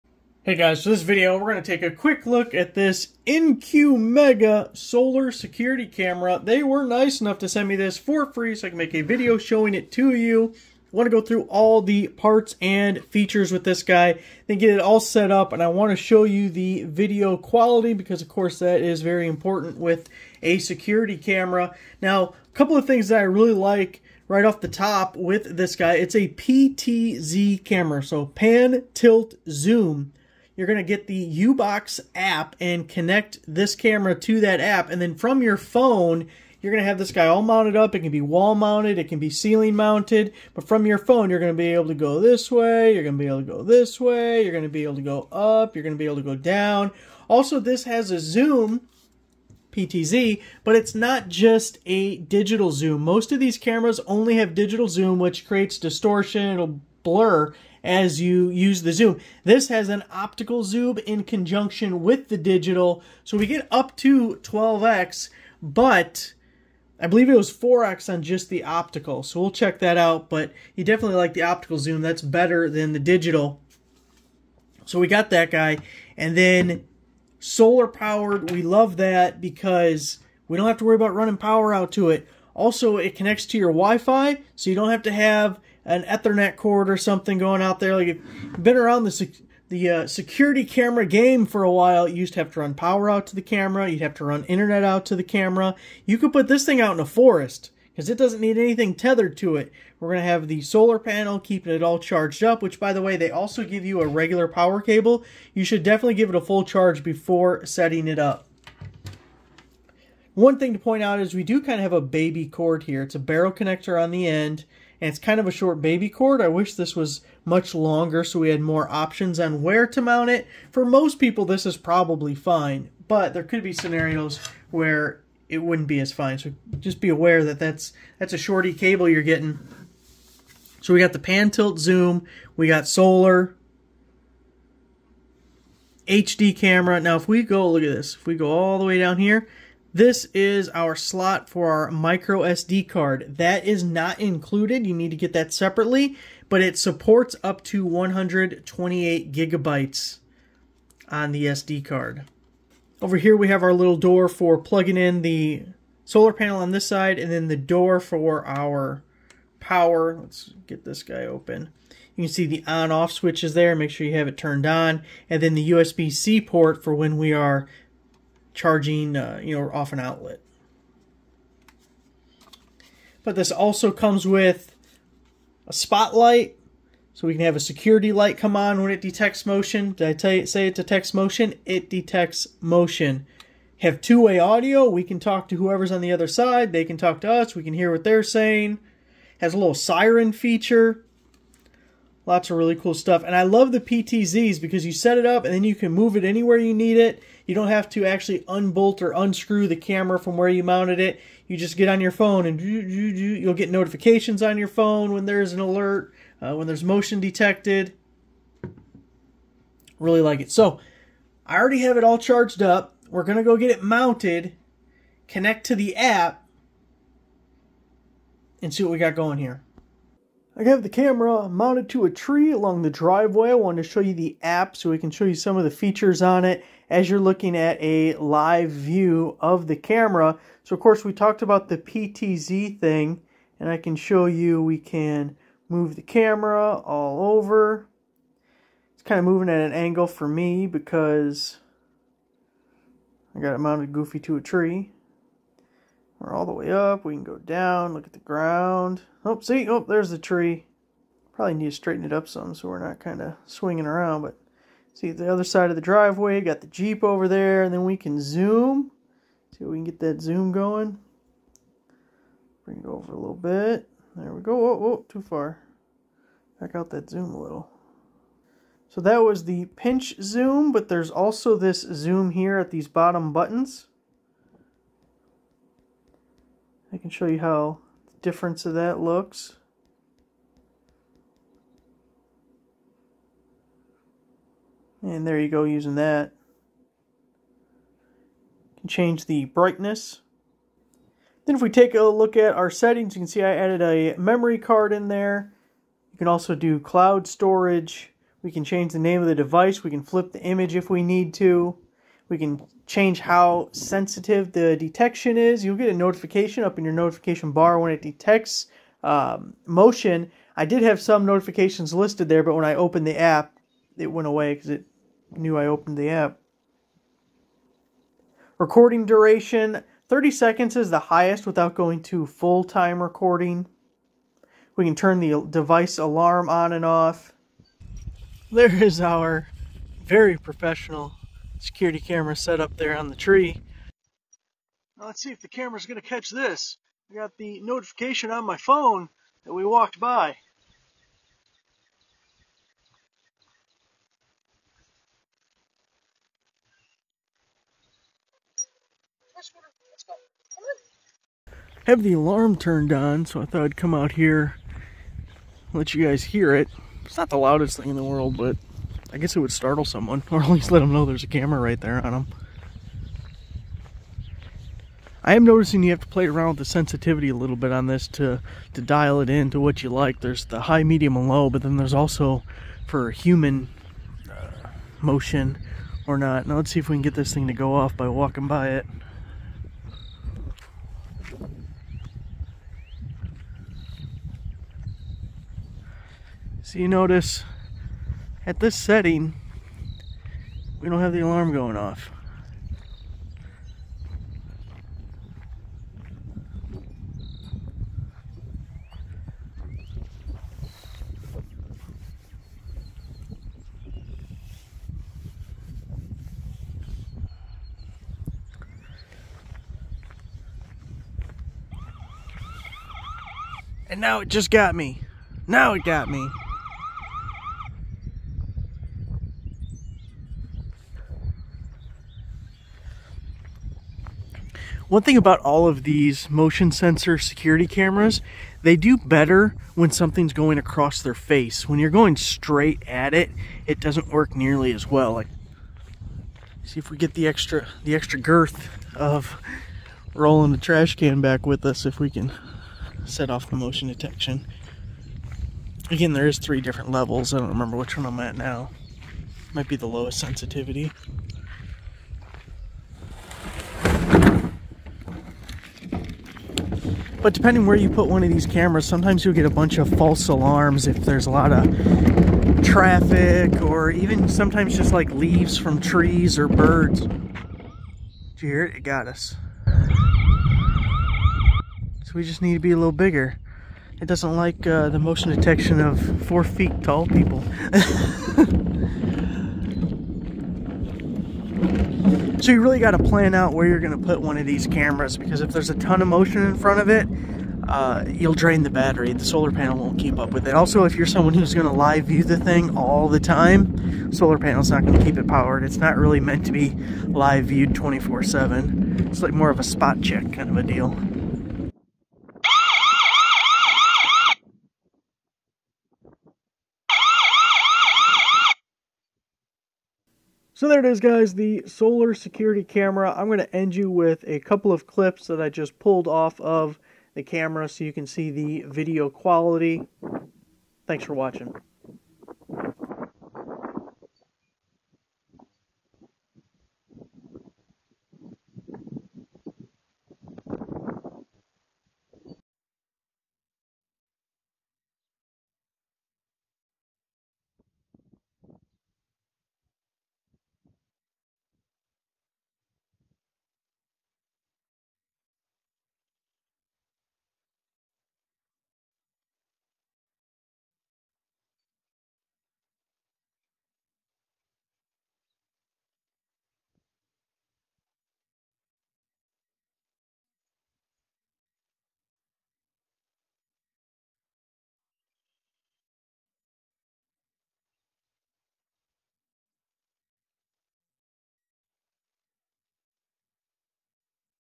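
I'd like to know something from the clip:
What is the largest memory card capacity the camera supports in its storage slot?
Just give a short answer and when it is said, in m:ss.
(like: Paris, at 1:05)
128 gigabytes, at 2:27.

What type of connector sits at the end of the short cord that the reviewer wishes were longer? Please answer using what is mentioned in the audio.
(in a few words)
Barrel connector.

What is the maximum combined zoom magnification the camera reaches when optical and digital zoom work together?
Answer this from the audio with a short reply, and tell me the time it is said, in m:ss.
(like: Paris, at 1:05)
12x, at 1:04.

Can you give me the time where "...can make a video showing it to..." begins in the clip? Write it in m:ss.
0:08.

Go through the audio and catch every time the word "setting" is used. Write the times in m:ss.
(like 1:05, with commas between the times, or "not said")
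1:47, 4:52, 6:28.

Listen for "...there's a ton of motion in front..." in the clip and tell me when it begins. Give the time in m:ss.
8:05.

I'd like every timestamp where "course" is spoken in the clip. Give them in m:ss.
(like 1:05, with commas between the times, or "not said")
0:18, 3:50.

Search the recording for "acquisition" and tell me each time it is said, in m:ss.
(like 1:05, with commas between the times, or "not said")
not said.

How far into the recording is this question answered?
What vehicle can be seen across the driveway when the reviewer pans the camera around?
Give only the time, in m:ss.
4:16.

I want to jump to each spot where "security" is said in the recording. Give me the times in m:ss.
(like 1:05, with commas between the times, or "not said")
0:05, 0:20, 1:30, 2:57, 5:31, 7:07, 8:32.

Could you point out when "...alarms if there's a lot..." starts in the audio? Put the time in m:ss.
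7:40.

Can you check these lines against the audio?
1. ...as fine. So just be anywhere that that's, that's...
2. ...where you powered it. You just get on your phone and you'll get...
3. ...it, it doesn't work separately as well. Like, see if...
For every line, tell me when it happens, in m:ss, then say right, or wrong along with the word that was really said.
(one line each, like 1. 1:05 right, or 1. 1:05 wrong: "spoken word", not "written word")
1. 2:05 wrong: "aware", not "anywhere"
2. 3:20 wrong: "mounted", not "powered"
3. 7:13 wrong: "nearly", not "separately".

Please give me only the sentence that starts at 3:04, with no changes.
We can talk to whoever's on the other side.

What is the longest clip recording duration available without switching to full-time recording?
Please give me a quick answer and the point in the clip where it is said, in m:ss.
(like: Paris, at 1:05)
30 seconds, at 5:20.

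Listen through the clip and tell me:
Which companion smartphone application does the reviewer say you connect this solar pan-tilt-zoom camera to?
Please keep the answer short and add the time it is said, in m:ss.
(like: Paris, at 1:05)
U-Box, at 0:31.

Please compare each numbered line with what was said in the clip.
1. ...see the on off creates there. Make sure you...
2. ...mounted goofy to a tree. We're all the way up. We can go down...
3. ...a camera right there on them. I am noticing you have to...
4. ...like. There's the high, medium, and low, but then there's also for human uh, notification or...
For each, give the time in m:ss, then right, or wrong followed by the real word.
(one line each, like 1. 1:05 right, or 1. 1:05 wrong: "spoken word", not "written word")
1. 2:42 wrong: "switches", not "creates"
2. 4:03 right
3. 6:01 right
4. 6:09 wrong: "motion", not "notification".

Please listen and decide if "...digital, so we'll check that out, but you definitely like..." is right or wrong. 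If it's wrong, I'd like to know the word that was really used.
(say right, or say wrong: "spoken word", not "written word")
wrong: "optical", not "digital".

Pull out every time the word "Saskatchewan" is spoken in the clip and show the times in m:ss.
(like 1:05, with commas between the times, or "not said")
not said.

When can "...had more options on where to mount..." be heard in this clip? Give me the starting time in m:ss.
1:58.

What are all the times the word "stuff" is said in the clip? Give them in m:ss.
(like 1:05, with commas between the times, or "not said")
3:12.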